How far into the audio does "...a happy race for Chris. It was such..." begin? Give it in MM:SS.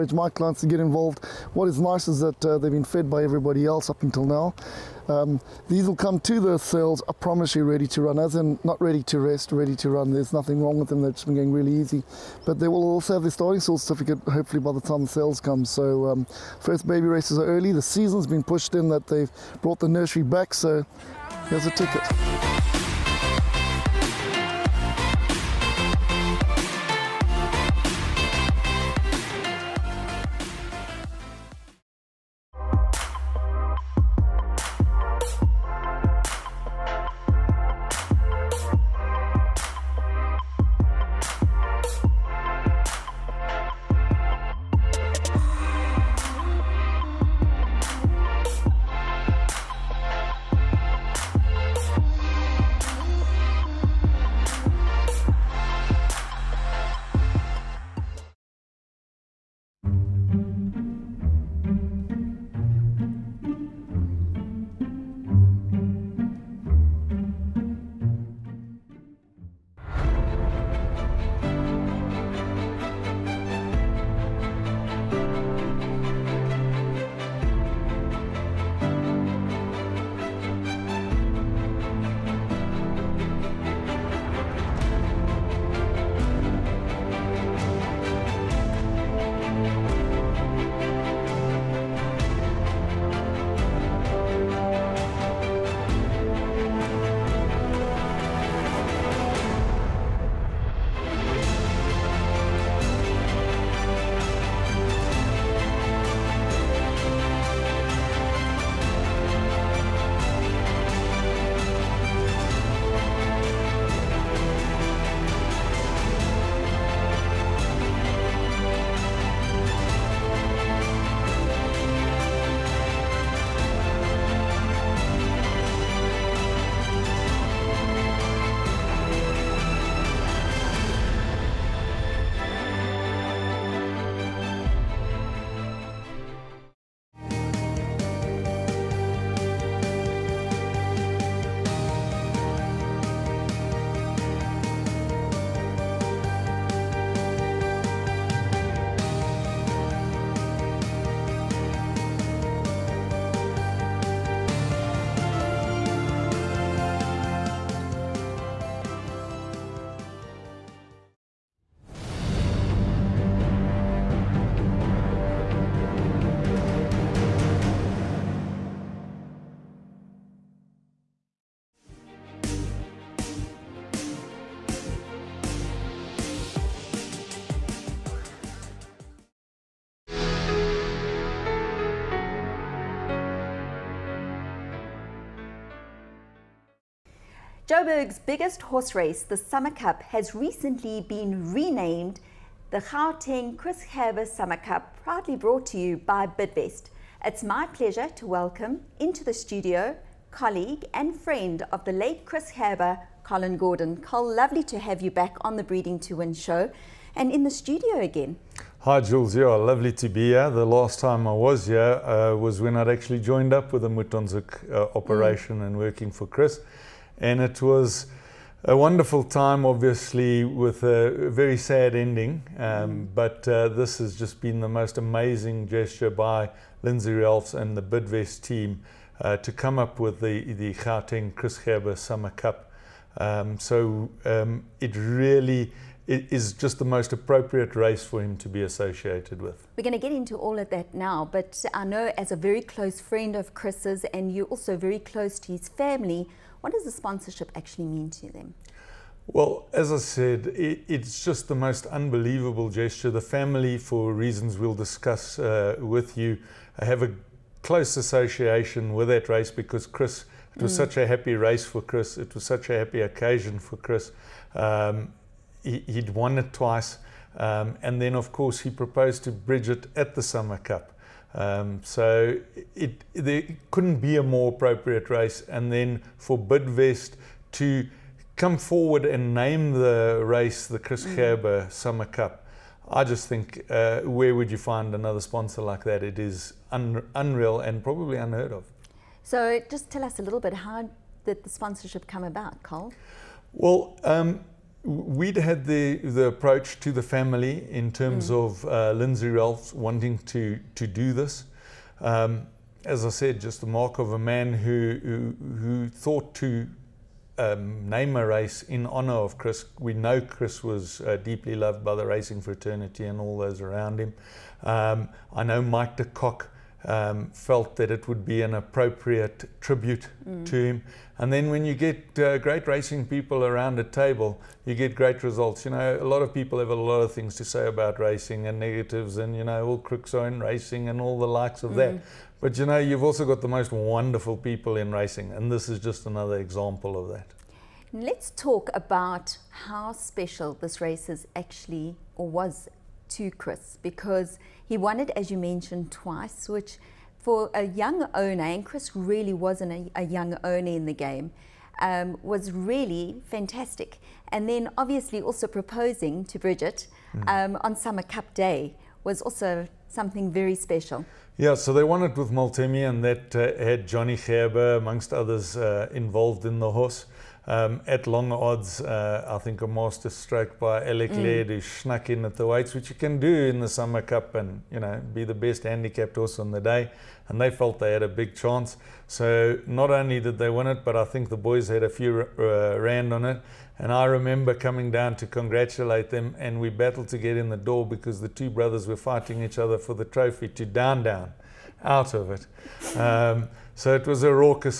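04:20.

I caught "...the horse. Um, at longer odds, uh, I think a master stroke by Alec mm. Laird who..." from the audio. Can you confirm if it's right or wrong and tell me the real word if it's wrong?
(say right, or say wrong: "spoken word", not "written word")
right.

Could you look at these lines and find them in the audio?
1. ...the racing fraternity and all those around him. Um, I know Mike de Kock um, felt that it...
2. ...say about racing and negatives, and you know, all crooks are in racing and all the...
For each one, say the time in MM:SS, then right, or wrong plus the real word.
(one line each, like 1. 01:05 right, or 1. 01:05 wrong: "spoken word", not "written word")
1. 05:11 right
2. 05:27 right.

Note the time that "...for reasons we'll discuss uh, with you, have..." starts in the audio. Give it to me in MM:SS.
04:13.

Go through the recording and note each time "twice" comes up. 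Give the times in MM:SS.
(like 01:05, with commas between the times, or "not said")
04:26, 05:45.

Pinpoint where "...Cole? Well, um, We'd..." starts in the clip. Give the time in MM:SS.
04:52.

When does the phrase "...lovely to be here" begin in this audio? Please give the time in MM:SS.
03:29.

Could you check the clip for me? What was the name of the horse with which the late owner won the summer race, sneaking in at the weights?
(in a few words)
Maltemi.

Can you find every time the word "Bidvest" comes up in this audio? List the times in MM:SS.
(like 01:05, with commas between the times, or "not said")
03:16, 03:47, 04:36.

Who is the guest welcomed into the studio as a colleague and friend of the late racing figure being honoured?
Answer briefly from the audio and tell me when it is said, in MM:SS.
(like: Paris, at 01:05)
Colin Gordon, at 03:23.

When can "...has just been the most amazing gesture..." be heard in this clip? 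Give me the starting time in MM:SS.
03:43.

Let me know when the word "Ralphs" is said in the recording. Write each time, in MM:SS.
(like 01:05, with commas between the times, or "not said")
03:47, 04:59.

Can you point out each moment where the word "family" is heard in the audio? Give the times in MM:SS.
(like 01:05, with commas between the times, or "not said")
04:05, 04:13, 04:57.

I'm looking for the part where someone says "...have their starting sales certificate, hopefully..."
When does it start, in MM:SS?
00:13.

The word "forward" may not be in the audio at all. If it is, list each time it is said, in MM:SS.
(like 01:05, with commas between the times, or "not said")
04:38.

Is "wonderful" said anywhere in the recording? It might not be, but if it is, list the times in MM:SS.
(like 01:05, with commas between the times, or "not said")
03:38, 05:33.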